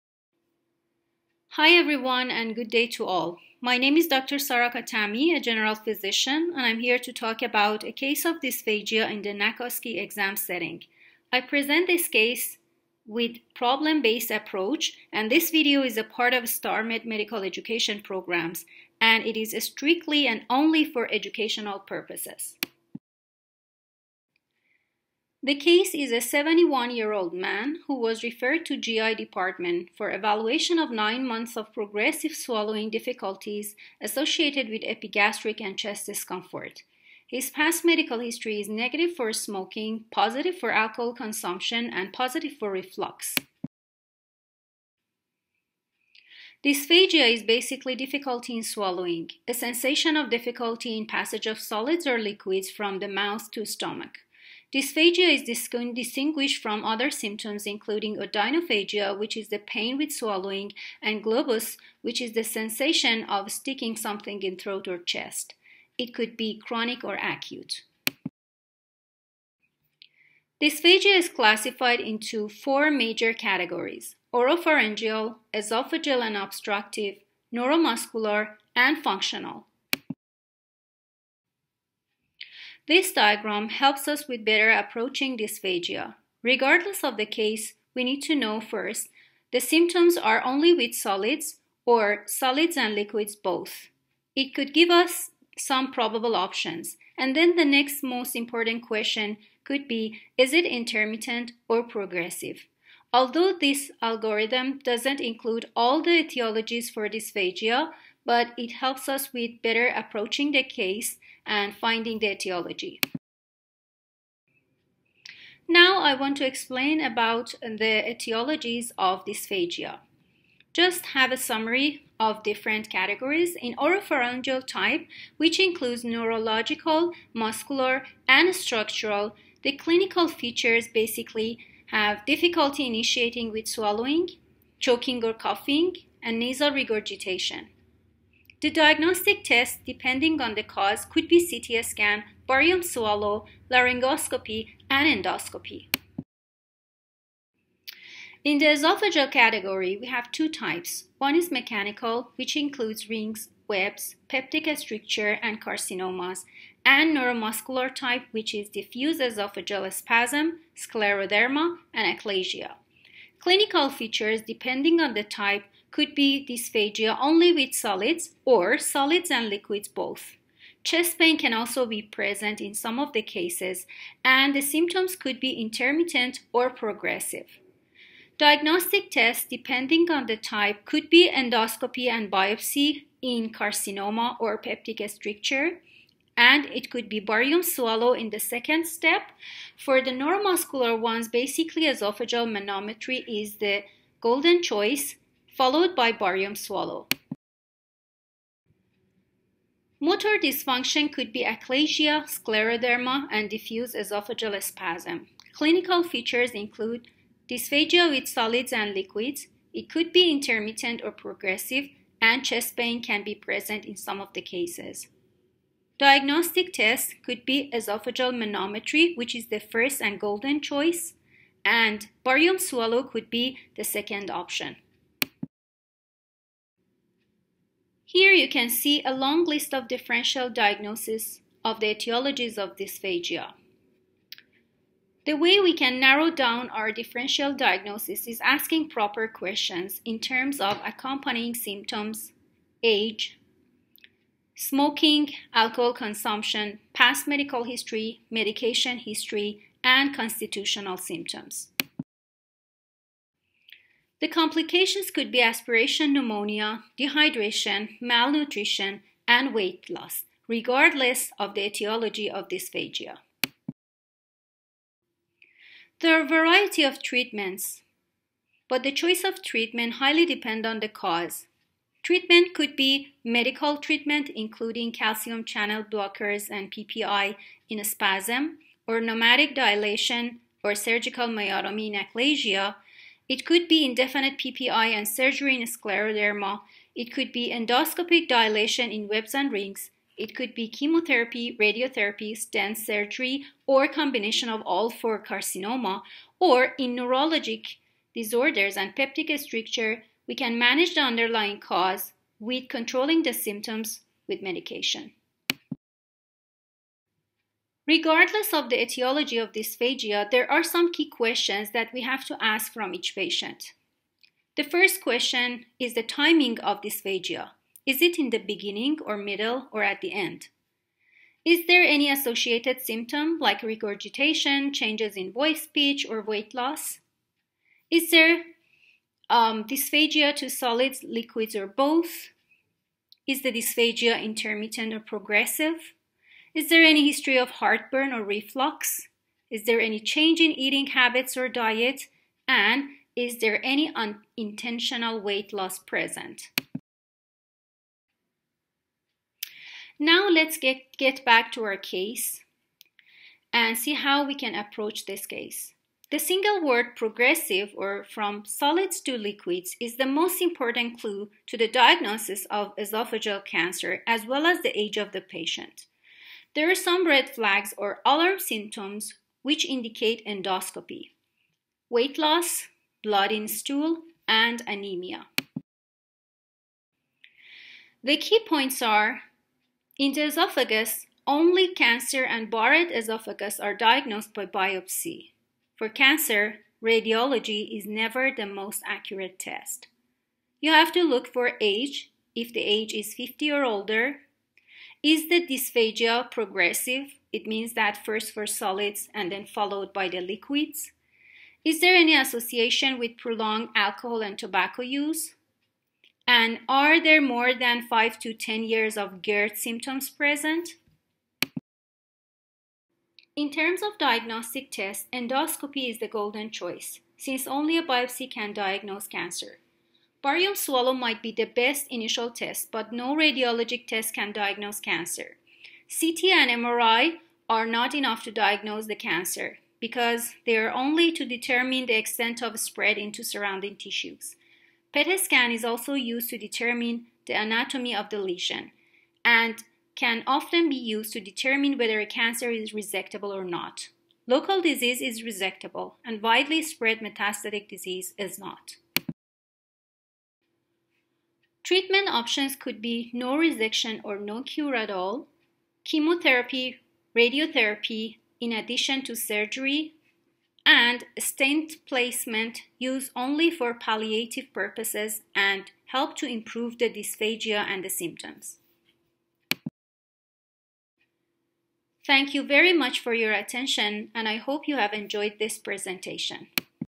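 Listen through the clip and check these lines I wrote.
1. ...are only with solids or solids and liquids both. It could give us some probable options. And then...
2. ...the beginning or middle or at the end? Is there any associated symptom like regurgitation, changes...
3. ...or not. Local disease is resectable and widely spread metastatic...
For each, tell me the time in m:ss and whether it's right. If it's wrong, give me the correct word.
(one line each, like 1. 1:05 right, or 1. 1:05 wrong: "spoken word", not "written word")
1. 1:30 right
2. 5:18 right
3. 7:23 right.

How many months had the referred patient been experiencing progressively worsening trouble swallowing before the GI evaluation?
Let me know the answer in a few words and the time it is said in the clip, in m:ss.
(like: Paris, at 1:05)
9, at 0:30.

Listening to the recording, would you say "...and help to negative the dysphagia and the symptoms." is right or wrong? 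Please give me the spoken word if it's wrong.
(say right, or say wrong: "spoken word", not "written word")
wrong: "improve", not "negative".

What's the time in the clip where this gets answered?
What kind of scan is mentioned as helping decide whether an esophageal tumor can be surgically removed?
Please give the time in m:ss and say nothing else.
7:14.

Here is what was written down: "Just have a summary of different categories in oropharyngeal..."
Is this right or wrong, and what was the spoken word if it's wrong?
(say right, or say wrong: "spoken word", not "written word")
right.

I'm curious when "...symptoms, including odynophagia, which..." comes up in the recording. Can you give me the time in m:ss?
0:57.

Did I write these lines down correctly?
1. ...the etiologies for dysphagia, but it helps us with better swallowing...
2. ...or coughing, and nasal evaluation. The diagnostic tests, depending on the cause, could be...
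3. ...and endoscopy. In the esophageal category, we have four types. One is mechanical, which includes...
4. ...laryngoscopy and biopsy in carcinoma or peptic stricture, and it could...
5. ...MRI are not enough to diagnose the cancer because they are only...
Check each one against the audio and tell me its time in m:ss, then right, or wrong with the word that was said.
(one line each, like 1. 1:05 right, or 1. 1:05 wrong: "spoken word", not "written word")
1. 1:46 wrong: "approaching", not "swallowing"
2. 2:15 wrong: "regurgitation", not "evaluation"
3. 2:24 wrong: "two", not "four"
4. 3:01 wrong: "endoscopy", not "laryngoscopy"
5. 7:06 right.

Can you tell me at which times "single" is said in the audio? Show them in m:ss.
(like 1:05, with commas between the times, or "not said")
5:56.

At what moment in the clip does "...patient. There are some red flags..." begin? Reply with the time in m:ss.
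6:05.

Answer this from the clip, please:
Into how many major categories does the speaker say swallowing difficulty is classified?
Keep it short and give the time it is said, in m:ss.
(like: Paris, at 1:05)
4, at 1:12.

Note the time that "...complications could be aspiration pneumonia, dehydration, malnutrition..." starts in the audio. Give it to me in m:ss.
4:14.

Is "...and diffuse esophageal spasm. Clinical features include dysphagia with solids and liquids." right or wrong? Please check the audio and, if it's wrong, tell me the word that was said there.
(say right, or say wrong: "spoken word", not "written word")
right.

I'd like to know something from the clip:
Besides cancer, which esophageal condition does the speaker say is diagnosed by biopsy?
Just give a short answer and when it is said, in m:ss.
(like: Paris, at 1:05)
Barrett esophagus, at 6:22.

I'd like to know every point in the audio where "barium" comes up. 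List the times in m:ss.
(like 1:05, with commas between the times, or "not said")
2:22, 3:07, 3:16, 3:42, 7:00.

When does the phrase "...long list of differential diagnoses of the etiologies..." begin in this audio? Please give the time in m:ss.
3:49.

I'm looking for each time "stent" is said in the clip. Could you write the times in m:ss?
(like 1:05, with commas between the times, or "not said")
4:52, 7:41.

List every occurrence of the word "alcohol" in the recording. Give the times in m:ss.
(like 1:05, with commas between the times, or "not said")
0:40, 4:05, 6:43.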